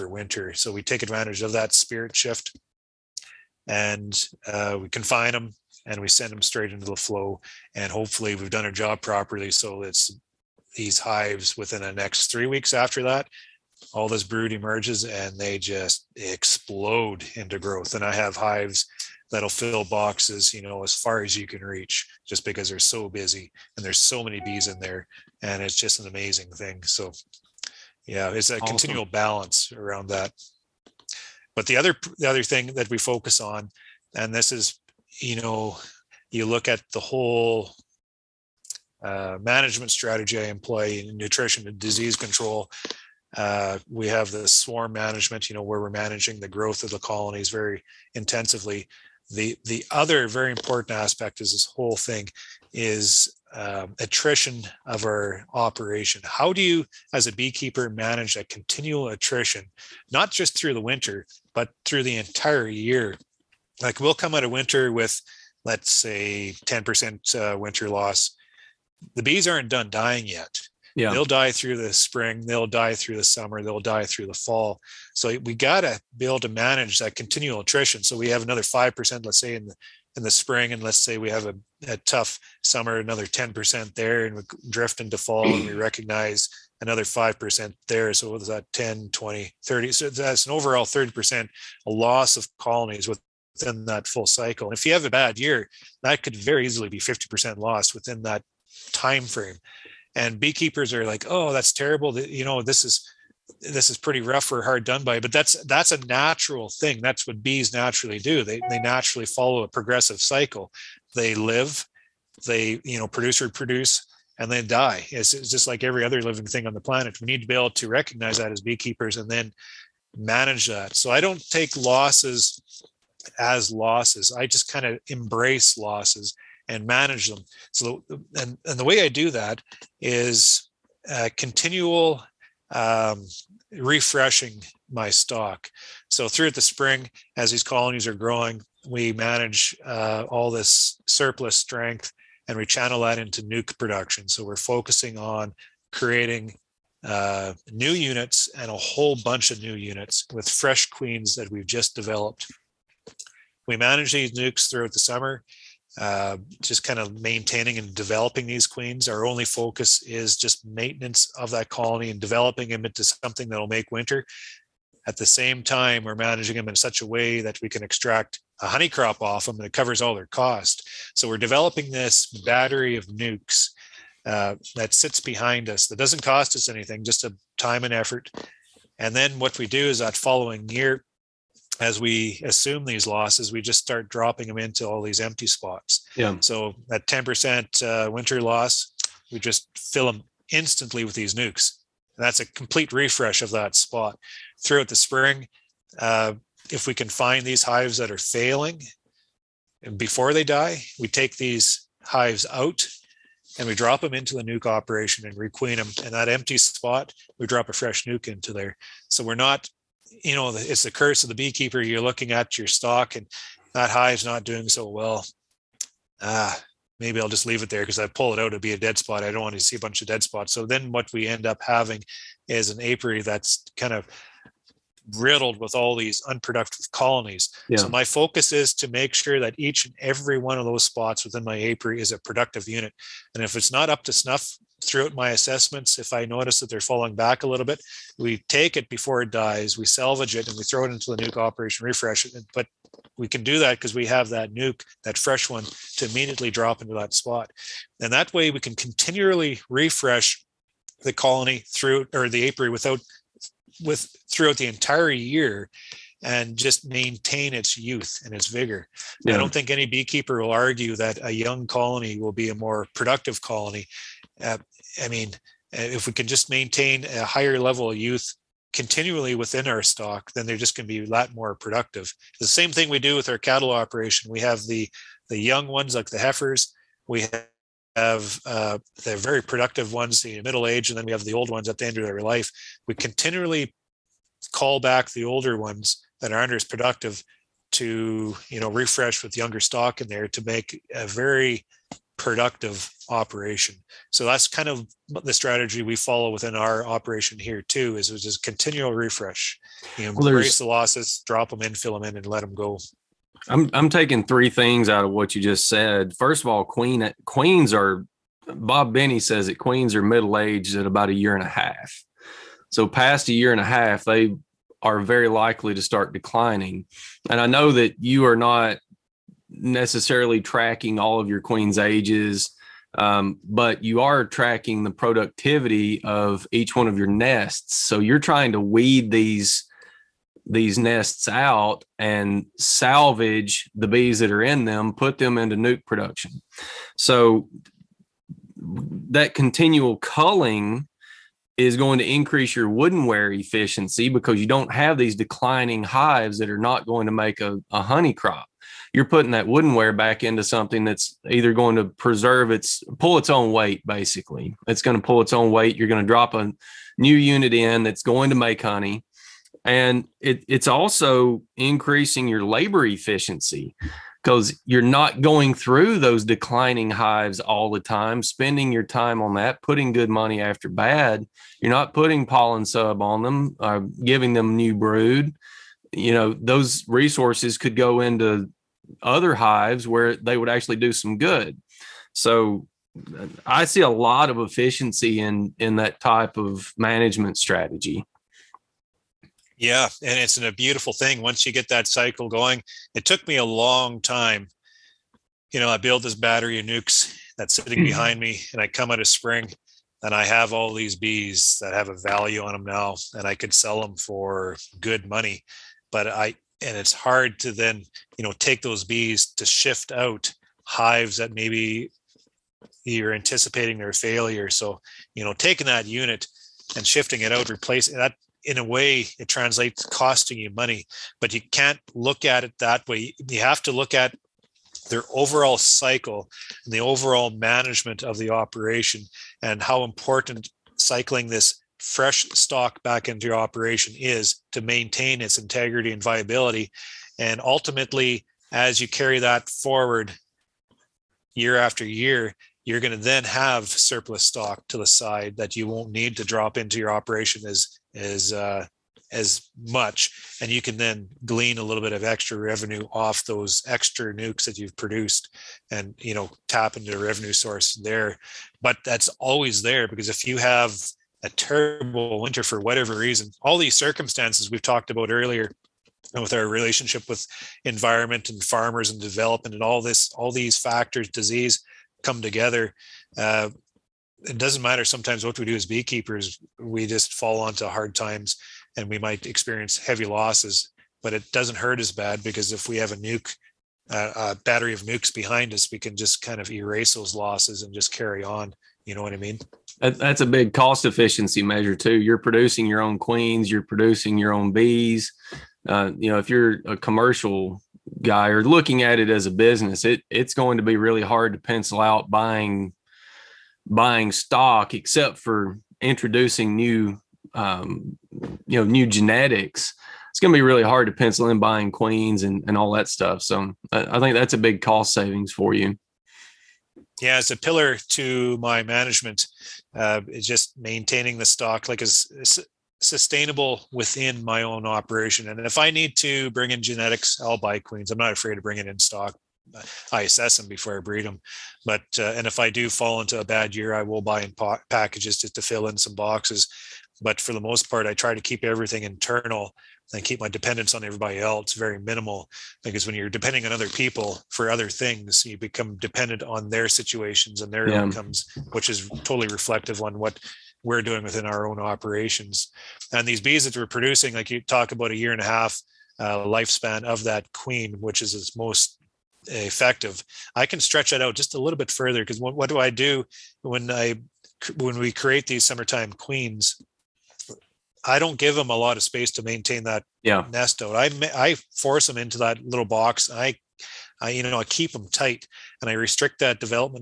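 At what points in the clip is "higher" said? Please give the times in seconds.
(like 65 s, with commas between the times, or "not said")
267 s.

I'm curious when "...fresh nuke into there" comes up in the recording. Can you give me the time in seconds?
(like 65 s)
207 s.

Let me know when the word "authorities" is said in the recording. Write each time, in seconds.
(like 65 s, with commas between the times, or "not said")
not said.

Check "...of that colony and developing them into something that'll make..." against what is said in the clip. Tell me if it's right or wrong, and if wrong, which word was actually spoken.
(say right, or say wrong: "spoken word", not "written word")
right.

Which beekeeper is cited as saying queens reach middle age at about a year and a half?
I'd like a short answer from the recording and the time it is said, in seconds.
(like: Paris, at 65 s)
Bob Binnie, at 308 s.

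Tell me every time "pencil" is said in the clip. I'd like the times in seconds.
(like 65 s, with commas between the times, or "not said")
501 s, 510 s.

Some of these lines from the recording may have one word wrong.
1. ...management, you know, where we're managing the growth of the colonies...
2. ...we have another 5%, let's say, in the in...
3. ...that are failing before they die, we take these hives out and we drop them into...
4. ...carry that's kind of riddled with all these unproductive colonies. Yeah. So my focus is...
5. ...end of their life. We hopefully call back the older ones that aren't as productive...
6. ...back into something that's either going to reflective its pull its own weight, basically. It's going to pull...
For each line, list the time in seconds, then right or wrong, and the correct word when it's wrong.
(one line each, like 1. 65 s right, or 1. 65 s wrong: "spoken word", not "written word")
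1. 44 s right
2. 78 s right
3. 197 s right
4. 222 s wrong: "apiary", not "carry"
5. 281 s wrong: "continually", not "hopefully"
6. 349 s wrong: "preserve", not "reflective".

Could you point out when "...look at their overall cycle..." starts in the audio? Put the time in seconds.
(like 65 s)
423 s.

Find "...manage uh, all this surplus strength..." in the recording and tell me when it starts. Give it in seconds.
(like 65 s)
139 s.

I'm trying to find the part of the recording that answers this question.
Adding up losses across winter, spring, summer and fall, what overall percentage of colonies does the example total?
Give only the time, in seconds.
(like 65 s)
90 s.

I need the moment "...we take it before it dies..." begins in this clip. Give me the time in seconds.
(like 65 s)
238 s.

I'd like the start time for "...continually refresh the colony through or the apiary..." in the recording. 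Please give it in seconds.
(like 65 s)
248 s.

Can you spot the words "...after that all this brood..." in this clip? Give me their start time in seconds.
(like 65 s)
12 s.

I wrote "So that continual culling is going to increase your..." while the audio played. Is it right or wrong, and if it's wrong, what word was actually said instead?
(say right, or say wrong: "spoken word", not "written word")
right.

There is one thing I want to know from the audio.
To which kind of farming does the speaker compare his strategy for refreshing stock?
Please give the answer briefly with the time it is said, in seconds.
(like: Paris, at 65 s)
cattle, at 273 s.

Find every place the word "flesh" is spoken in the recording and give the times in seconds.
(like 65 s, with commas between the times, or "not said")
not said.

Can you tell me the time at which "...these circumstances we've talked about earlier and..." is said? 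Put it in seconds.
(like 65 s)
463 s.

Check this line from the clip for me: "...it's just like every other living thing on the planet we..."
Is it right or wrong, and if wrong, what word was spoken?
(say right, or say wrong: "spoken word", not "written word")
right.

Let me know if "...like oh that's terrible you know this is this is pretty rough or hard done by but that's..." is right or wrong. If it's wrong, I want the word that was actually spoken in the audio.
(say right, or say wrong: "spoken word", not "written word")
right.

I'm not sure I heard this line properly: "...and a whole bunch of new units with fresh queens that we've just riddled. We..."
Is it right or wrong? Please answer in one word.
wrong.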